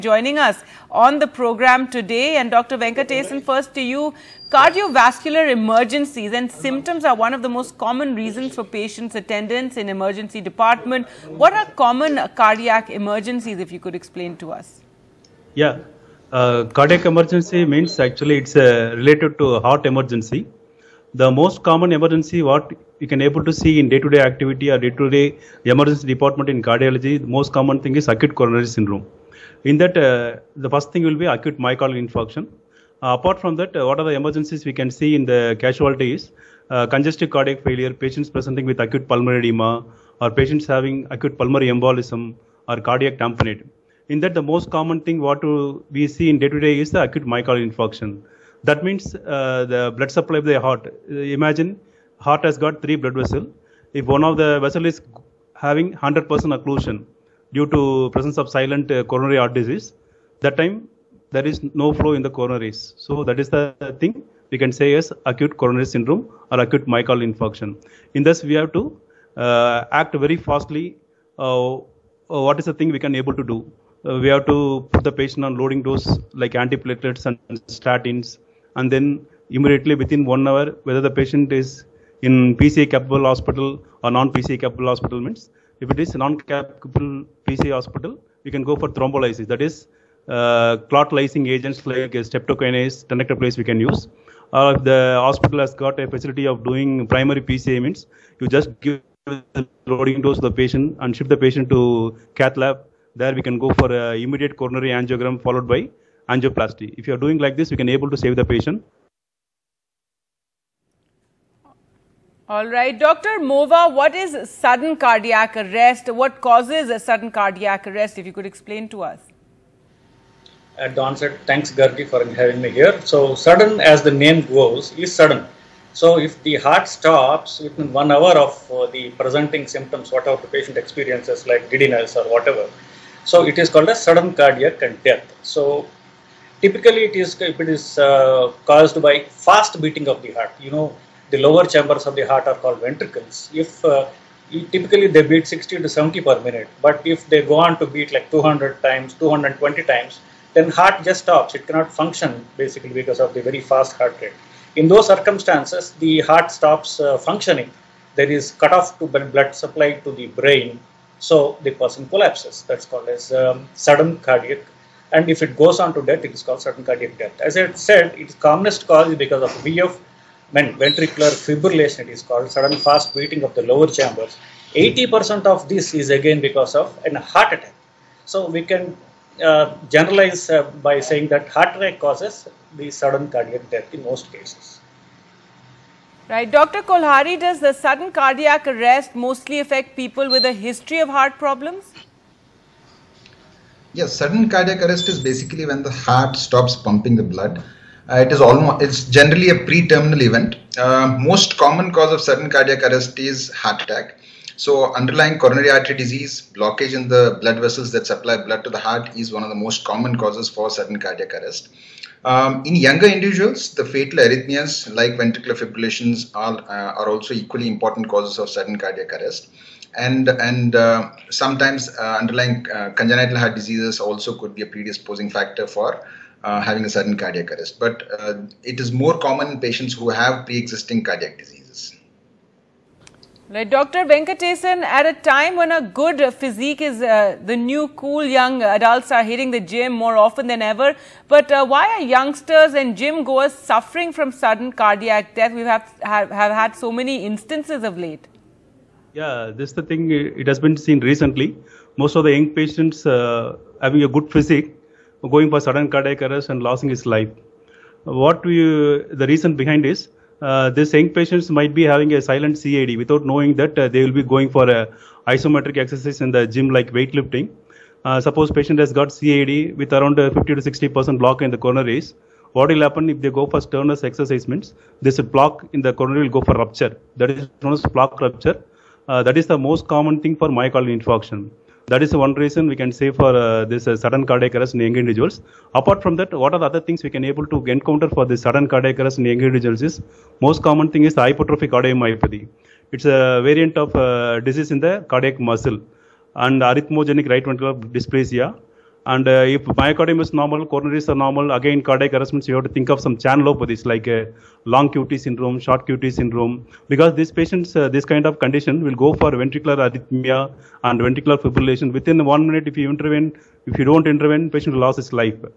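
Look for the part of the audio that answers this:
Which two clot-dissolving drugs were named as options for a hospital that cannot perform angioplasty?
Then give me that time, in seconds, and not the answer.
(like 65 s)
92 s.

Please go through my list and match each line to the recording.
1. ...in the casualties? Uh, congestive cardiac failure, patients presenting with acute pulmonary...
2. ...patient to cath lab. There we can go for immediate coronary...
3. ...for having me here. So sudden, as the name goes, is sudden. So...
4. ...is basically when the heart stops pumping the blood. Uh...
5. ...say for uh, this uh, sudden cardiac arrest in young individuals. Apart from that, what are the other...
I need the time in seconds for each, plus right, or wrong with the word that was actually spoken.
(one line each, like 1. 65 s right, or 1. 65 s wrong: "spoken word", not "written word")
1. 35 s right
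2. 101 s right
3. 122 s right
4. 195 s right
5. 282 s right.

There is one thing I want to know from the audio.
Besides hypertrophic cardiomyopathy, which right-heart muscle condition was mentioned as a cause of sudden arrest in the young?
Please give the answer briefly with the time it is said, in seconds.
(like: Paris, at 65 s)
arrhythmogenic right ventricular dysplasia, at 296 s.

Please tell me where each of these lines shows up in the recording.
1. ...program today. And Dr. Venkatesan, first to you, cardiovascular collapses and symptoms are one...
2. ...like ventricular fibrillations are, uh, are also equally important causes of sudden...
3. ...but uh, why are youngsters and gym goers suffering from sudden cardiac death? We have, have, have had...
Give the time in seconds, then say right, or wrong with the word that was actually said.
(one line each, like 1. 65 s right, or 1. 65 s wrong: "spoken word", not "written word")
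1. 1 s wrong: "emergencies", not "collapses"
2. 214 s right
3. 241 s right.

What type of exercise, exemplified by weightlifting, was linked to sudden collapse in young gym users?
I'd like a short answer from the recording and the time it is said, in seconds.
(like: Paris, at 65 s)
isometric exercise, at 265 s.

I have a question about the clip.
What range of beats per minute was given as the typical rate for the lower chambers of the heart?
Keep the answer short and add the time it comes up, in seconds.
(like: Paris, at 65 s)
60 to 70, at 145 s.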